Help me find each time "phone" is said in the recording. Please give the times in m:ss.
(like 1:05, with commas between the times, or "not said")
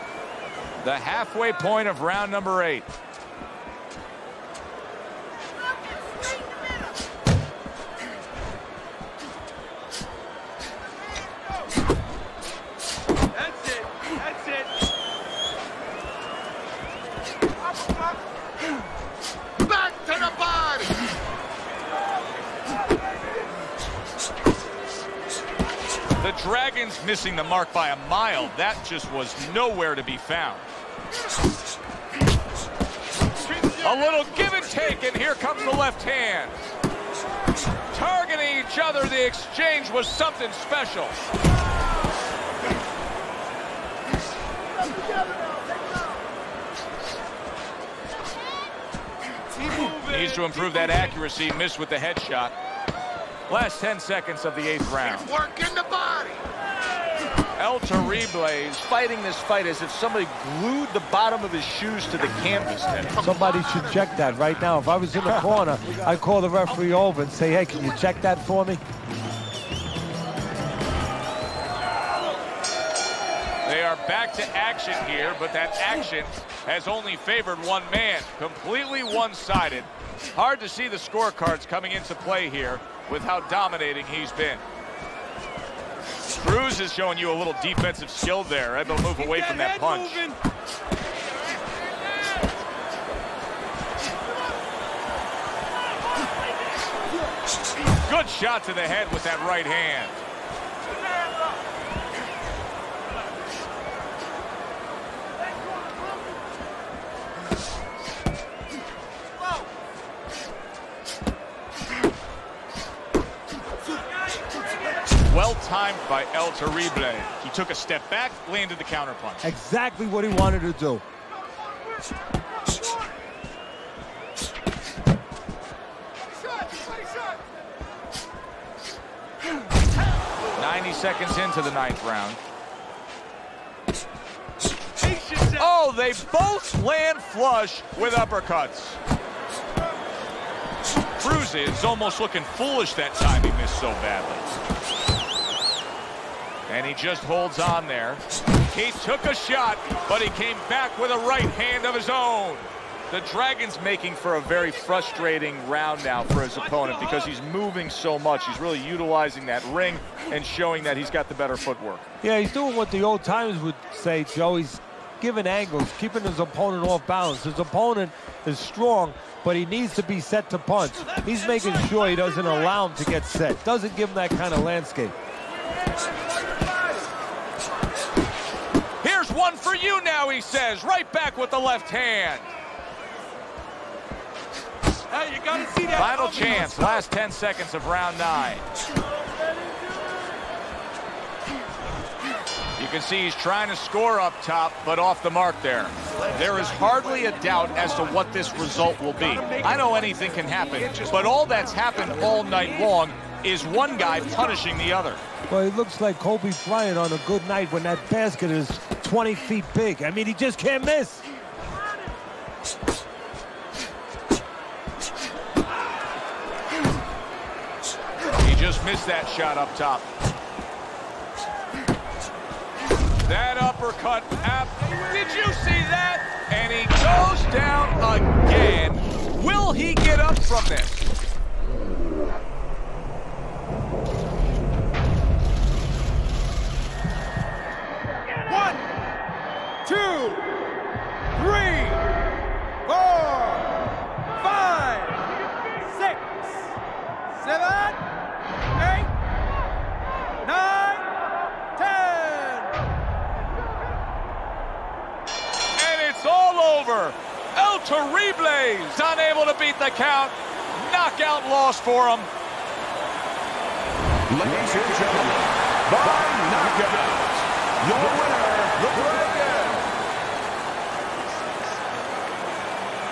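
not said.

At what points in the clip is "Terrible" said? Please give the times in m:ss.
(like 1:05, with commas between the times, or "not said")
0:57, 1:56, 4:17.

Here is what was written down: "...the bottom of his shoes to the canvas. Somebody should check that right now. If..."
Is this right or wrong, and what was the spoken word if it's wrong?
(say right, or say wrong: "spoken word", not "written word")
right.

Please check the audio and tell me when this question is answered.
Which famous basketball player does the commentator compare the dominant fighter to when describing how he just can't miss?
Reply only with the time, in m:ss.
3:26.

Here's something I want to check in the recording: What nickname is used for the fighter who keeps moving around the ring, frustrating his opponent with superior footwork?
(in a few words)
The Dragon.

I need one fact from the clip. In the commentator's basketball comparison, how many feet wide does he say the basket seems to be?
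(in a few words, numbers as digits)
20 feet.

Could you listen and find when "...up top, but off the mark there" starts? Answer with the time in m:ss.
3:14.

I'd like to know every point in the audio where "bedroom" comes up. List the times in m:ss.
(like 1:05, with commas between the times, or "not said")
not said.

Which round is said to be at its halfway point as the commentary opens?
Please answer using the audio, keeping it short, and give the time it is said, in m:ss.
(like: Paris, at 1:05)
8, at 0:02.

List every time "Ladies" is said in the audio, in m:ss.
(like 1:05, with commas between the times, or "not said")
4:24.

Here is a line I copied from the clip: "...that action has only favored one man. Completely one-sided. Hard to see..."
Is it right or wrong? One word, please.
right.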